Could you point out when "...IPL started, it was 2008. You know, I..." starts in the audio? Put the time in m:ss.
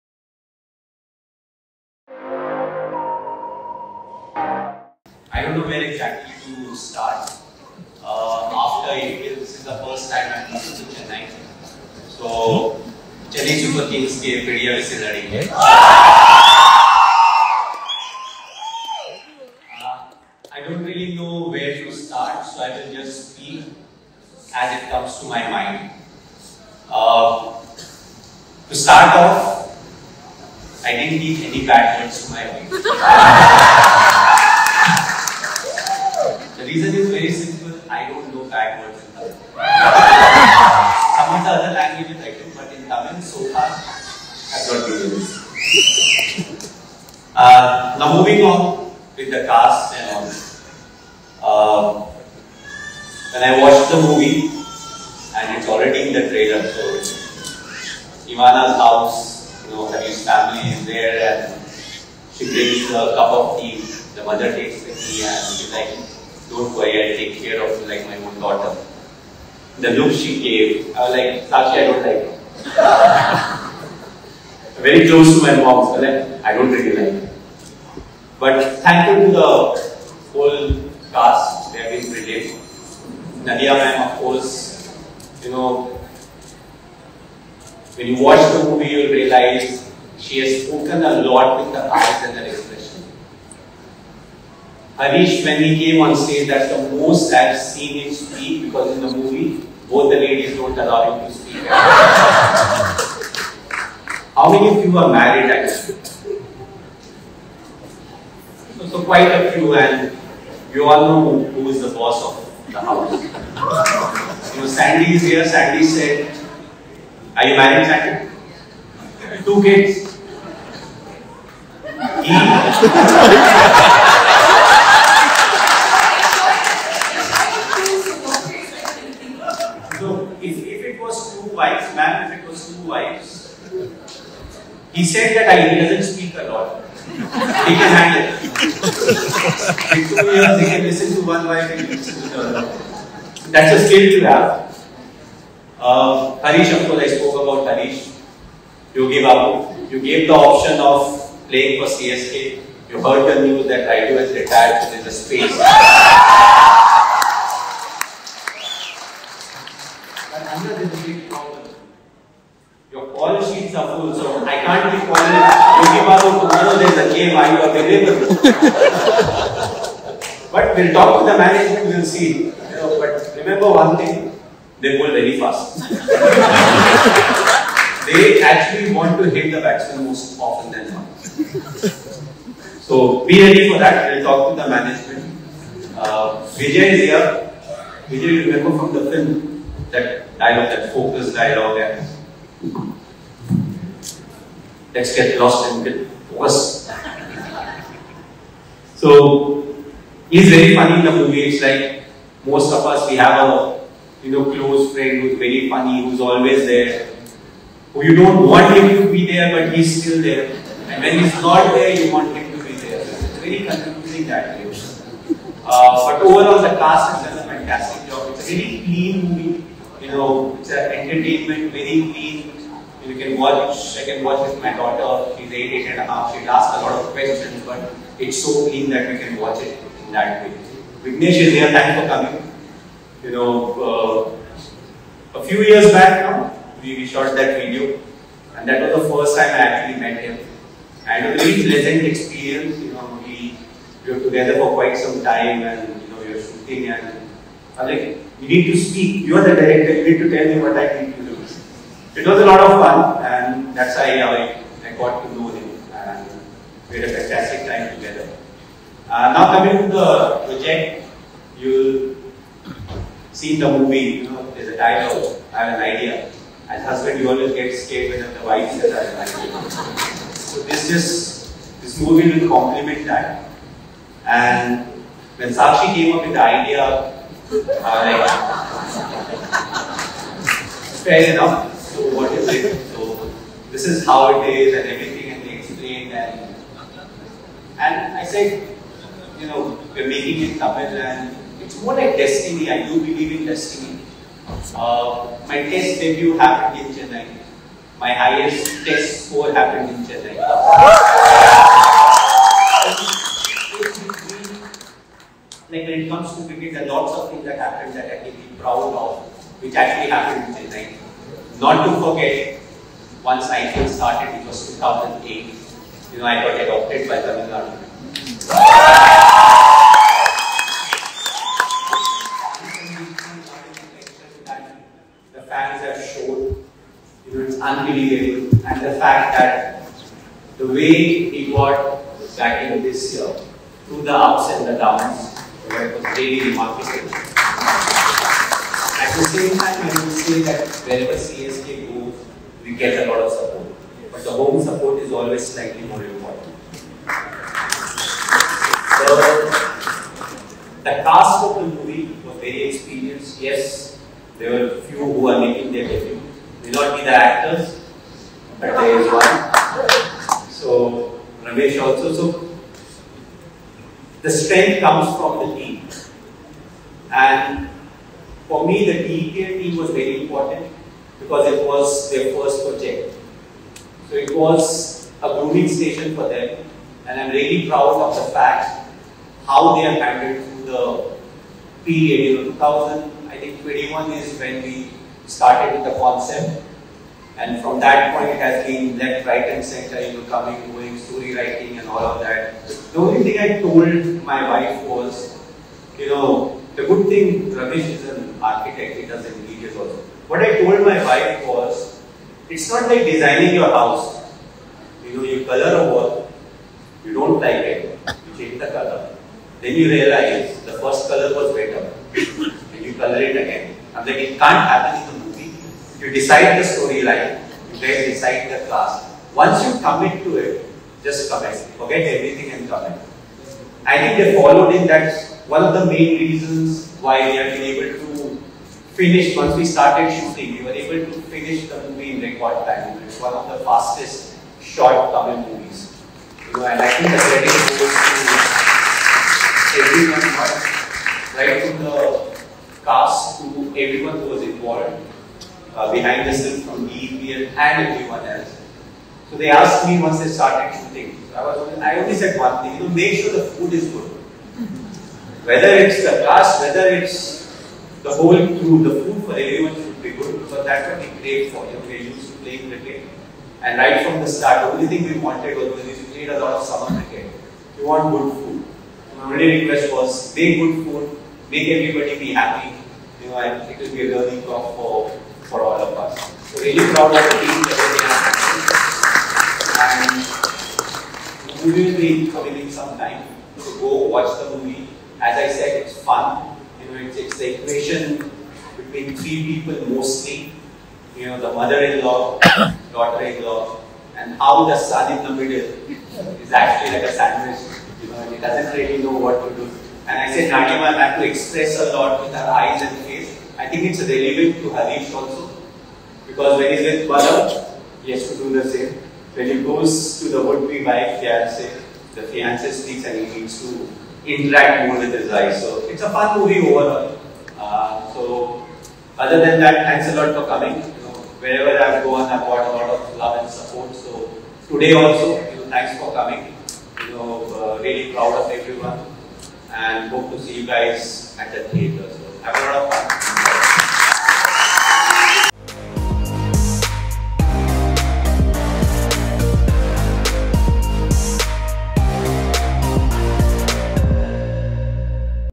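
5:13.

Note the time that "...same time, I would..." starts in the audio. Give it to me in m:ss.
5:39.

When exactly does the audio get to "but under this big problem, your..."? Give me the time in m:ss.
2:40.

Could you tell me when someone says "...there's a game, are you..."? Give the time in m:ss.
2:46.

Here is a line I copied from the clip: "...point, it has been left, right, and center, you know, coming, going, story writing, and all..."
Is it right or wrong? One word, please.
right.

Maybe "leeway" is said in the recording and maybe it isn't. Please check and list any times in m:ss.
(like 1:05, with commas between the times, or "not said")
not said.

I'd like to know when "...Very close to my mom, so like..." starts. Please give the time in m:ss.
1:14.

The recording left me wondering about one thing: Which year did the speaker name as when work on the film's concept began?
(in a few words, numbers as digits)
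2021.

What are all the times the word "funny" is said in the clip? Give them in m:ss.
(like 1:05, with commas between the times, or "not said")
3:20, 3:25.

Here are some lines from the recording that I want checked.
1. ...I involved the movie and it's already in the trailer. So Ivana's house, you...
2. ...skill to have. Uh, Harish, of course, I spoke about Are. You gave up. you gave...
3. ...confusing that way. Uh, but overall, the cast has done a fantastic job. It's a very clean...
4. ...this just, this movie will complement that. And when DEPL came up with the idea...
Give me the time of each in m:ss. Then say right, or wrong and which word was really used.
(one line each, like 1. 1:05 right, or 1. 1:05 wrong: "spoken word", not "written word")
1. 0:53 wrong: "watched", not "involved"
2. 2:23 wrong: "Harish", not "Are"
3. 3:33 right
4. 4:30 wrong: "Sakshi", not "DEPL".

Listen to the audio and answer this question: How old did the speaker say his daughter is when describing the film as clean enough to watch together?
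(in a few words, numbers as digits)
8 and a half.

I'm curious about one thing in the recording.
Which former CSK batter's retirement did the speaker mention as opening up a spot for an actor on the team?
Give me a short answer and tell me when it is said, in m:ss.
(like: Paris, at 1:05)
Rayudu, at 2:33.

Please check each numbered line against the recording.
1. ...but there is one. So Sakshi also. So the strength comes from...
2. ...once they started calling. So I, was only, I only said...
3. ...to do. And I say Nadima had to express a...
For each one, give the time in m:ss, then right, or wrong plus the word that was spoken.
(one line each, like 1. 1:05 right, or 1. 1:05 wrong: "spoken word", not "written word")
1. 5:58 wrong: "Ramesh", not "Sakshi"
2. 7:30 wrong: "shooting", not "calling"
3. 8:19 right.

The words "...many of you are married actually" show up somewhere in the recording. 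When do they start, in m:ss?
1:44.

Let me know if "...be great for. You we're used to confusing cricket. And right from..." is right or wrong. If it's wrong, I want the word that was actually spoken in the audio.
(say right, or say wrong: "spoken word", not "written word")
wrong: "playing", not "confusing".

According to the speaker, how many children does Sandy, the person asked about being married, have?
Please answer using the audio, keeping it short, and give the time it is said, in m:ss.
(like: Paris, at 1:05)
2, at 1:59.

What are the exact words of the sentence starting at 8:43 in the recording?
So today also, you know, thanks for coming.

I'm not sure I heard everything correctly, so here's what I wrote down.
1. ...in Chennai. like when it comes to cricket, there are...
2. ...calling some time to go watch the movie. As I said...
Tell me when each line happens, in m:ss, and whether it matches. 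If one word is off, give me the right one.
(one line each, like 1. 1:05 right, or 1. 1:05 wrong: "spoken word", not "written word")
1. 4:59 right
2. 8:02 wrong: "committing", not "calling".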